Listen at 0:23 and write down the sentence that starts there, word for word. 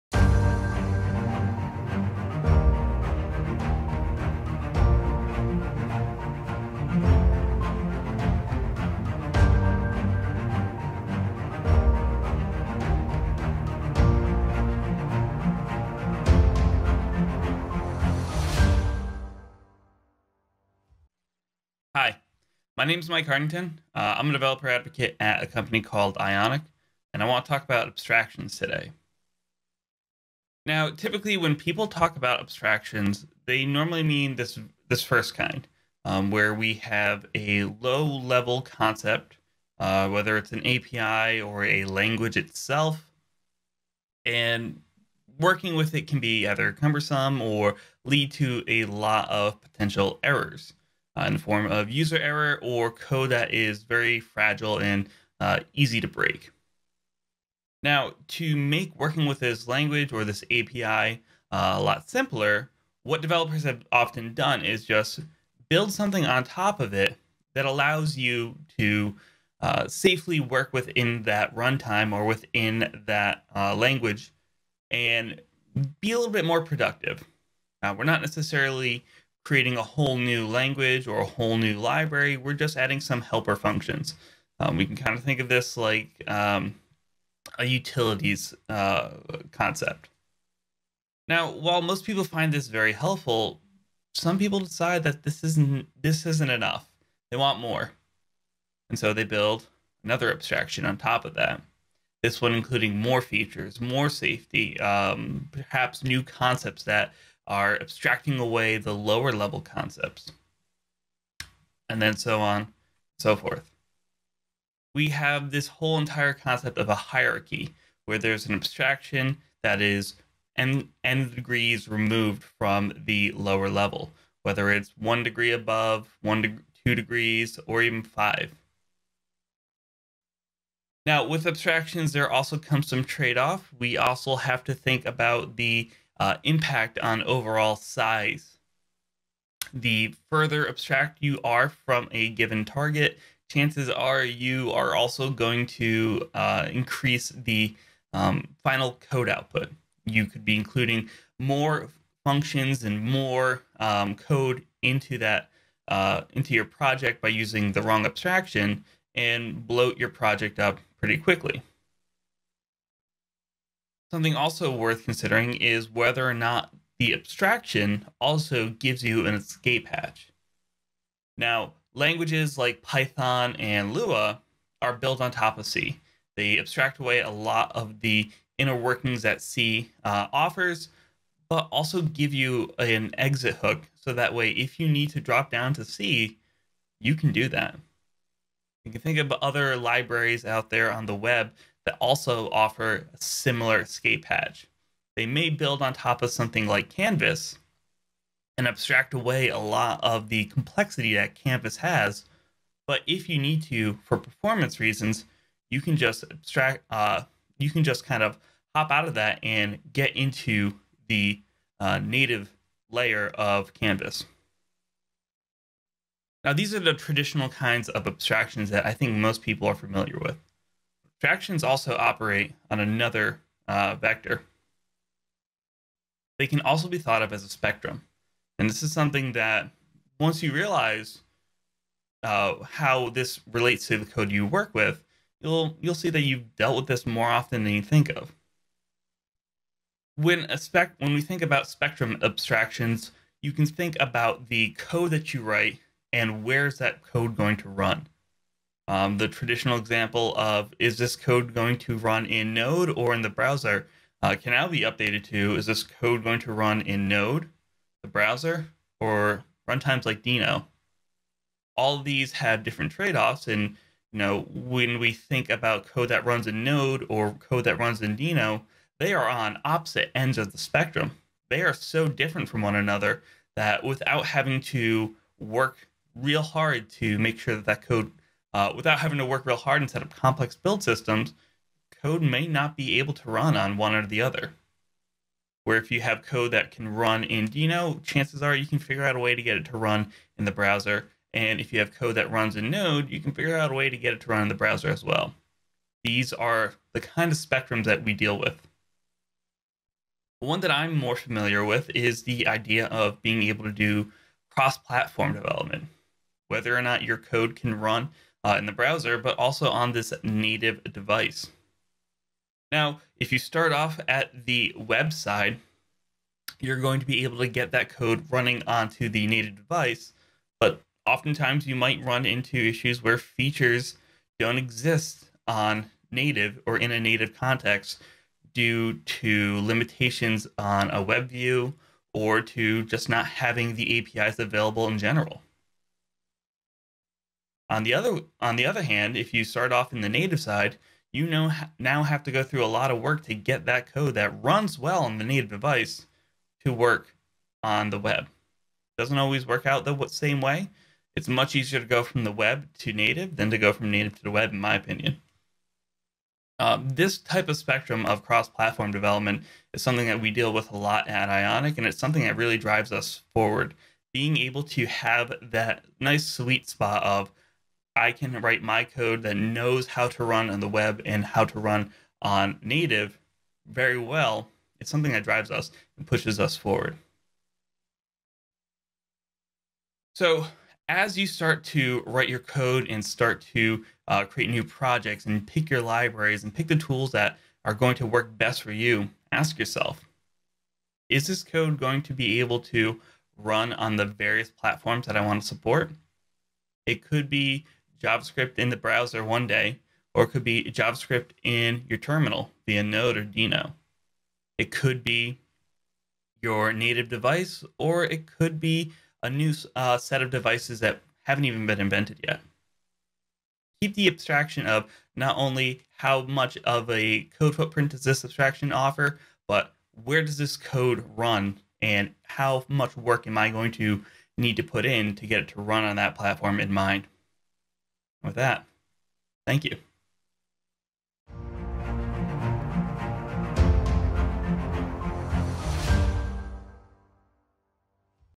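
Uh, I'm a developer advocate at a company called Ionic, and I want to talk about abstractions today.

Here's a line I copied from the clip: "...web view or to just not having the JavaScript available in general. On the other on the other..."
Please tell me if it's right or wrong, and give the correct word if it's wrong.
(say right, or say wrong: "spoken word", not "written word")
wrong: "APIs", not "JavaScript".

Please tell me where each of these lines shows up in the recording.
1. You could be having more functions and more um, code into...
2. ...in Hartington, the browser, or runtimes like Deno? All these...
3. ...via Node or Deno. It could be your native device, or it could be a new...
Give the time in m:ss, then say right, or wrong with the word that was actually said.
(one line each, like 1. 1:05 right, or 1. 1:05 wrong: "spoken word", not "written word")
1. 2:30 wrong: "including", not "having"
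2. 4:16 wrong: "Node", not "Hartington"
3. 6:42 right.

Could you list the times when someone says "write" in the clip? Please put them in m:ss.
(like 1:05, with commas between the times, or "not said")
4:05, 6:08, 6:22.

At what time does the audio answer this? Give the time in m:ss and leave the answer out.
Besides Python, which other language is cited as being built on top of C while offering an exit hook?
2:53.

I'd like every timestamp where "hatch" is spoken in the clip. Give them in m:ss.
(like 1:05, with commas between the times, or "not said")
2:49, 3:14.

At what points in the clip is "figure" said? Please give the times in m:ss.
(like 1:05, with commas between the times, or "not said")
4:48, 4:53.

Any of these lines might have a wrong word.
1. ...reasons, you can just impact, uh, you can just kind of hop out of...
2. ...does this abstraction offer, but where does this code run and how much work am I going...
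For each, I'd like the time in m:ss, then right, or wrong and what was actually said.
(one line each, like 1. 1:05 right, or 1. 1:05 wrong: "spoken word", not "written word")
1. 3:24 wrong: "abstract", not "impact"
2. 6:57 right.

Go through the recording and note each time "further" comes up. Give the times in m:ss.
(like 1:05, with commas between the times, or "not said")
2:20.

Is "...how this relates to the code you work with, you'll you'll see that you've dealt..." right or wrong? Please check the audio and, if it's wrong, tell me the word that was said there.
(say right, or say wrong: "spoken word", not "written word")
right.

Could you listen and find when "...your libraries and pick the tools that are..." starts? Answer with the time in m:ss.
6:25.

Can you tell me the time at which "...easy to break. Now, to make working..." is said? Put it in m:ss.
0:55.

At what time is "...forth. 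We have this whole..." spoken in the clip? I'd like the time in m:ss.
1:53.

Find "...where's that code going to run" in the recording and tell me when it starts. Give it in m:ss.
4:06.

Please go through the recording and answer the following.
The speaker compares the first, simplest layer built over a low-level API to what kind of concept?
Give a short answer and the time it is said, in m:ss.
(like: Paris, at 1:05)
utilities, at 1:27.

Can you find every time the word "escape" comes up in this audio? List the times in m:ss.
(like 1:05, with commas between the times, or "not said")
2:49, 3:13.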